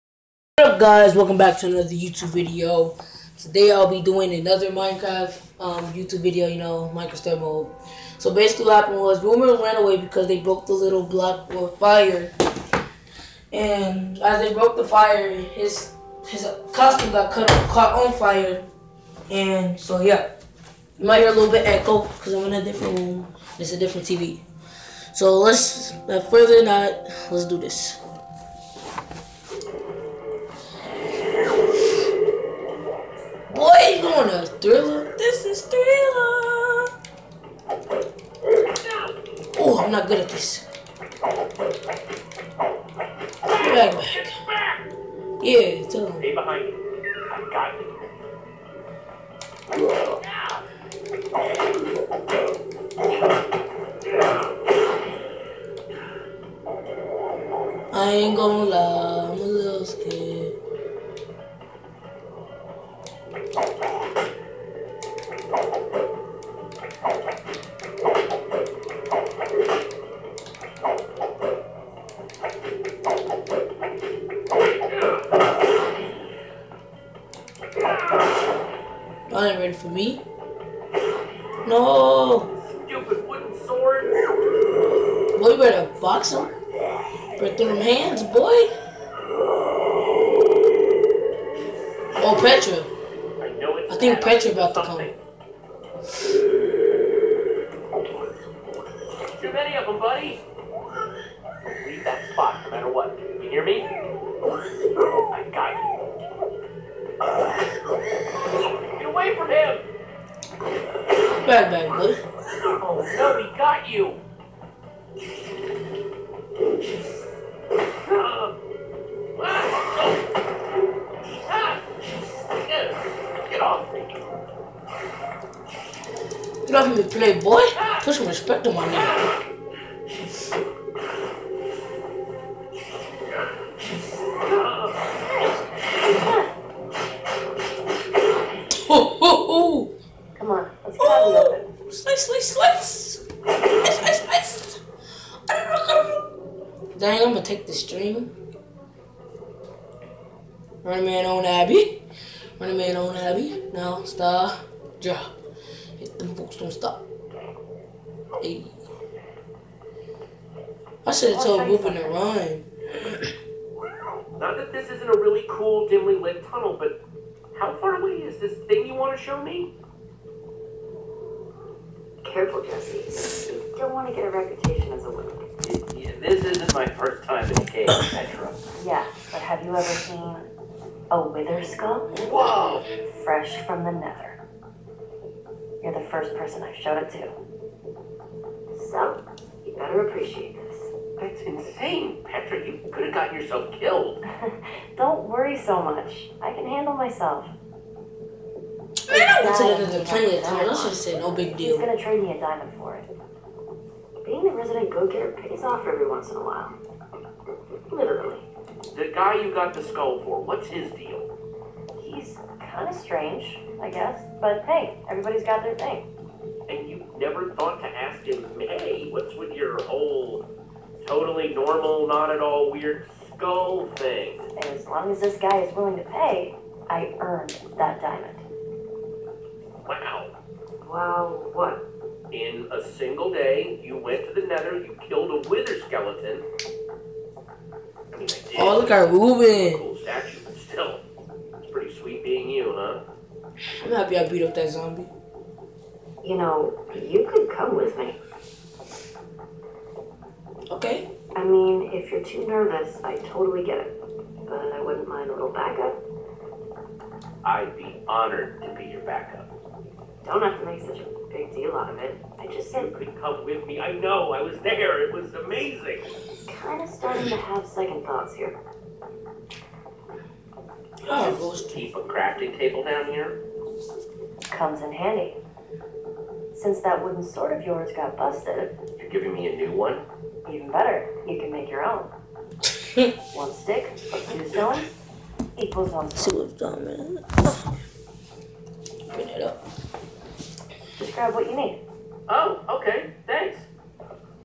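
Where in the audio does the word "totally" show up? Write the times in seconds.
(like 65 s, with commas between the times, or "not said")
221 s, 253 s.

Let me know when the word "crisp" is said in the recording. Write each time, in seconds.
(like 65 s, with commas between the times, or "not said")
not said.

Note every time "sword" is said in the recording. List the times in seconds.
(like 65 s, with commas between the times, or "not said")
83 s, 277 s.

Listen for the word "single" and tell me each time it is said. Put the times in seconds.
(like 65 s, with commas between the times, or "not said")
232 s.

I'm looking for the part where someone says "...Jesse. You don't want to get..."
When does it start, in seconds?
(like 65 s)
172 s.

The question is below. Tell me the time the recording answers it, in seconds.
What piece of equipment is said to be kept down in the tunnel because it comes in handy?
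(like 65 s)
272 s.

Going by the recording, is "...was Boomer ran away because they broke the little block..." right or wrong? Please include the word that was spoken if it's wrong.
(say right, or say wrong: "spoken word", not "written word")
right.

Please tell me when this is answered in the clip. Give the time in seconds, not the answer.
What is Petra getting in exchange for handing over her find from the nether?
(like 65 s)
202 s.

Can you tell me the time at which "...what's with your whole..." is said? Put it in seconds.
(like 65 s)
219 s.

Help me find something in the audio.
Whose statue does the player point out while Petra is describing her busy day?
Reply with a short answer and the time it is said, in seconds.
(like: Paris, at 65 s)
Reuben, at 239 s.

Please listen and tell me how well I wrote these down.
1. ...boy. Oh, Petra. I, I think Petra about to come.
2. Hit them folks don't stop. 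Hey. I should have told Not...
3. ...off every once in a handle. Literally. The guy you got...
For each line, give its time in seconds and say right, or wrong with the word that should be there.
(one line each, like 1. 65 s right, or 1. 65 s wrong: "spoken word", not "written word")
1. 88 s right
2. 155 s wrong: "Whoopin", not "Not"
3. 205 s wrong: "while", not "handle".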